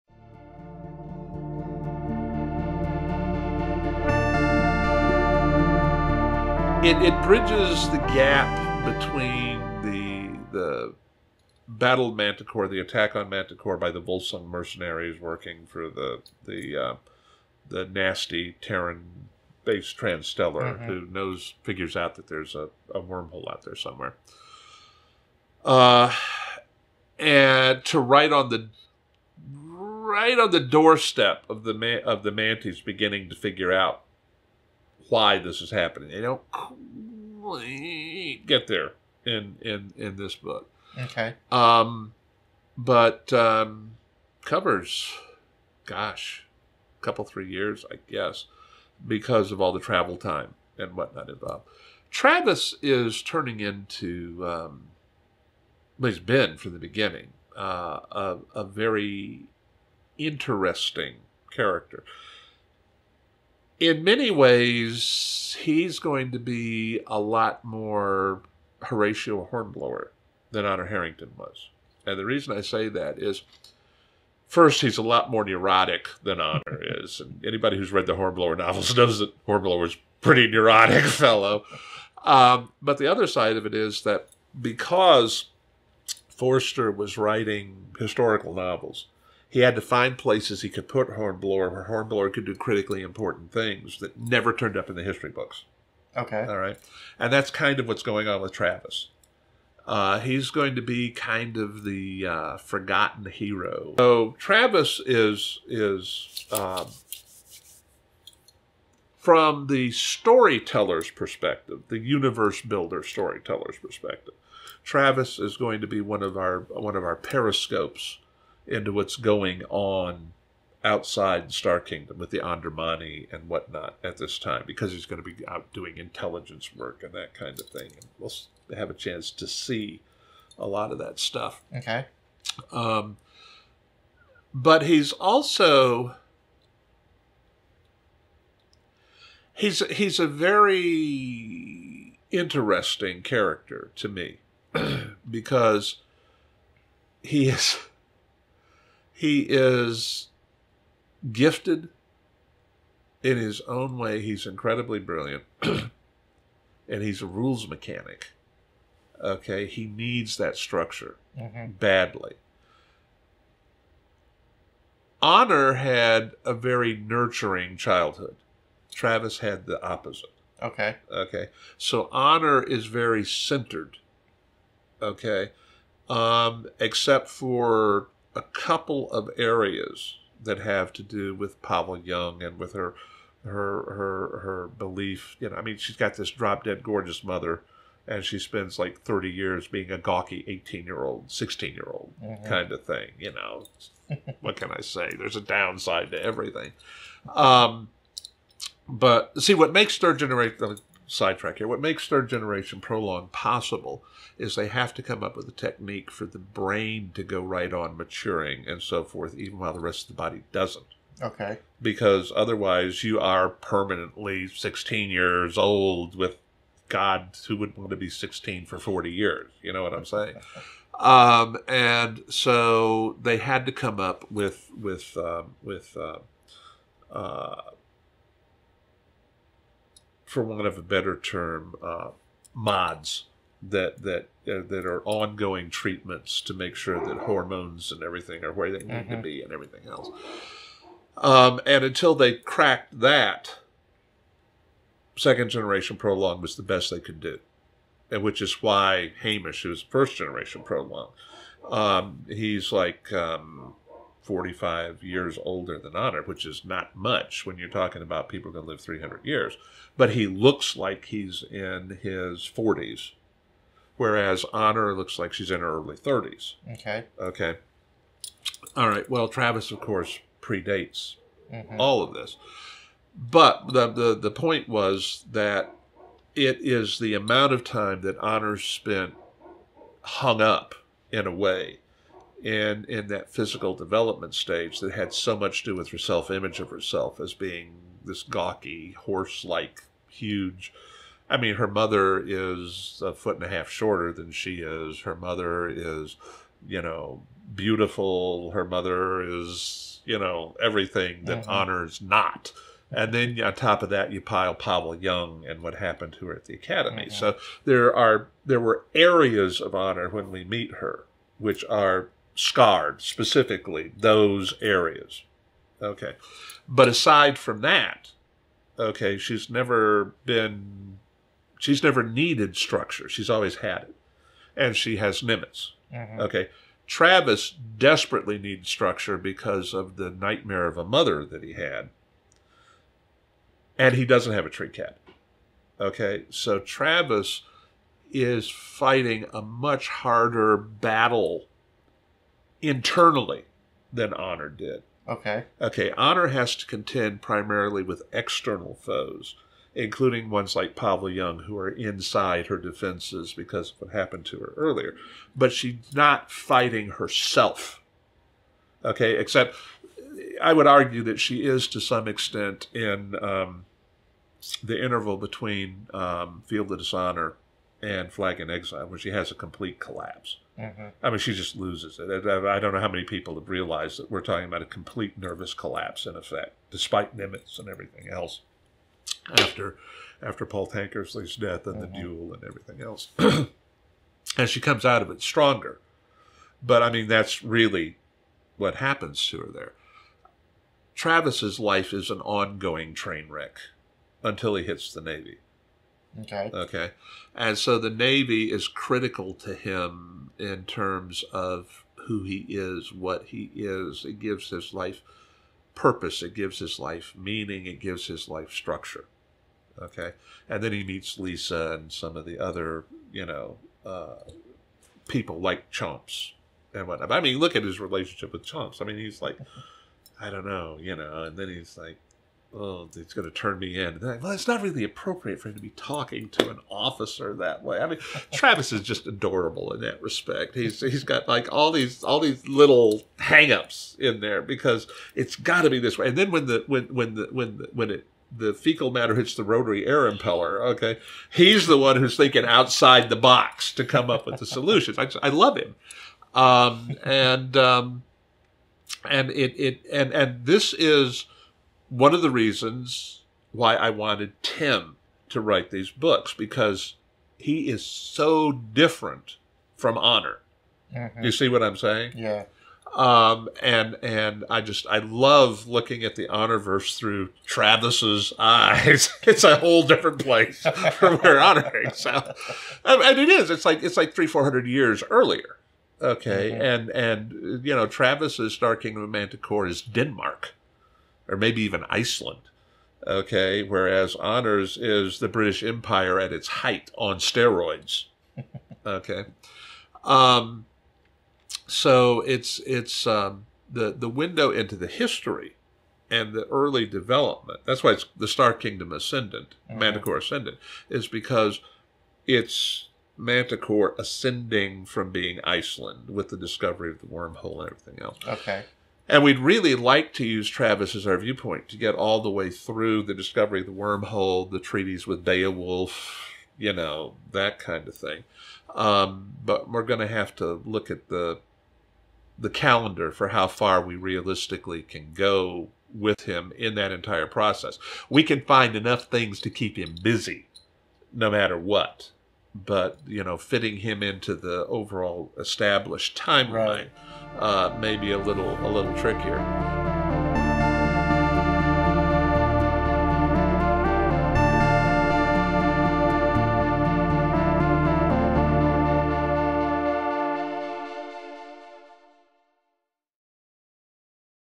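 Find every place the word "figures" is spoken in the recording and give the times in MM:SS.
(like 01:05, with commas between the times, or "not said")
00:21, 00:33.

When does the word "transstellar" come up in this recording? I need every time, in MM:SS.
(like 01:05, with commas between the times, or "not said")
00:19.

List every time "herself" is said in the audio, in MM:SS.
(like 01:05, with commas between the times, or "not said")
04:46, 05:56.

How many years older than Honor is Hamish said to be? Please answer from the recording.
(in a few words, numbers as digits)
45.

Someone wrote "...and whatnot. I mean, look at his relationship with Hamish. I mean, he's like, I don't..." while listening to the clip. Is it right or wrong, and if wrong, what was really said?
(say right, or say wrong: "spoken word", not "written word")
wrong: "Chomps", not "Hamish".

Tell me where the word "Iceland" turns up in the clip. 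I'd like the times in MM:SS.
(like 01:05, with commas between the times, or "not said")
08:01, 08:25.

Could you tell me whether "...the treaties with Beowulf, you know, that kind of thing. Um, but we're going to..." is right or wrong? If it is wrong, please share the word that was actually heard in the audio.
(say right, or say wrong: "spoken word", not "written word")
right.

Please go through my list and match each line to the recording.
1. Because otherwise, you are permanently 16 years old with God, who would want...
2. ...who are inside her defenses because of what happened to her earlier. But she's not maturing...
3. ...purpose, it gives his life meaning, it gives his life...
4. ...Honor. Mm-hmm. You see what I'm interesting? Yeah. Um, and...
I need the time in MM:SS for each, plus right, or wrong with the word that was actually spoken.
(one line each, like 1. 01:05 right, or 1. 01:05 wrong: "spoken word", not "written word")
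1. 03:31 right
2. 05:51 wrong: "fighting", not "maturing"
3. 06:45 right
4. 07:39 wrong: "saying", not "interesting".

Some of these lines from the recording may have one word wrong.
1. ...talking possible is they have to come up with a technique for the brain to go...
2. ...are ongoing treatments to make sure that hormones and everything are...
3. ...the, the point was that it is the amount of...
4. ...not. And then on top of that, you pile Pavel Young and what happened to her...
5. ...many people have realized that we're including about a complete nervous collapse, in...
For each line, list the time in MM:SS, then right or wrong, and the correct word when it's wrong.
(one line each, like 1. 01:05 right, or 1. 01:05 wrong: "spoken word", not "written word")
1. 03:22 wrong: "prolong", not "talking"
2. 03:54 right
3. 04:33 right
4. 05:02 right
5. 06:12 wrong: "talking", not "including".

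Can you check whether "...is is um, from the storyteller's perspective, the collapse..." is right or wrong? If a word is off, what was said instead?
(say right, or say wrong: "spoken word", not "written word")
wrong: "universe", not "collapse".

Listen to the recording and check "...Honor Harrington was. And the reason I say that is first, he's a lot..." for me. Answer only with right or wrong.
right.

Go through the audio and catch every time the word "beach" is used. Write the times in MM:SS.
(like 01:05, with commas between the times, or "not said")
not said.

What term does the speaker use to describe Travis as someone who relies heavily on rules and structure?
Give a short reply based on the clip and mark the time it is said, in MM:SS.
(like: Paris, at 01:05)
rules mechanic, at 02:37.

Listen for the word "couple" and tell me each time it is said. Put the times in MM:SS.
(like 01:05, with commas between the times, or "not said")
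00:47, 02:58.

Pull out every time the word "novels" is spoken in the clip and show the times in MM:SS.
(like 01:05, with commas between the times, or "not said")
01:18, 01:28.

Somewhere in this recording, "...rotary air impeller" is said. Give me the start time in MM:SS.
07:19.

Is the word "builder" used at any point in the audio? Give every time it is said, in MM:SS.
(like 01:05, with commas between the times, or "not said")
01:52.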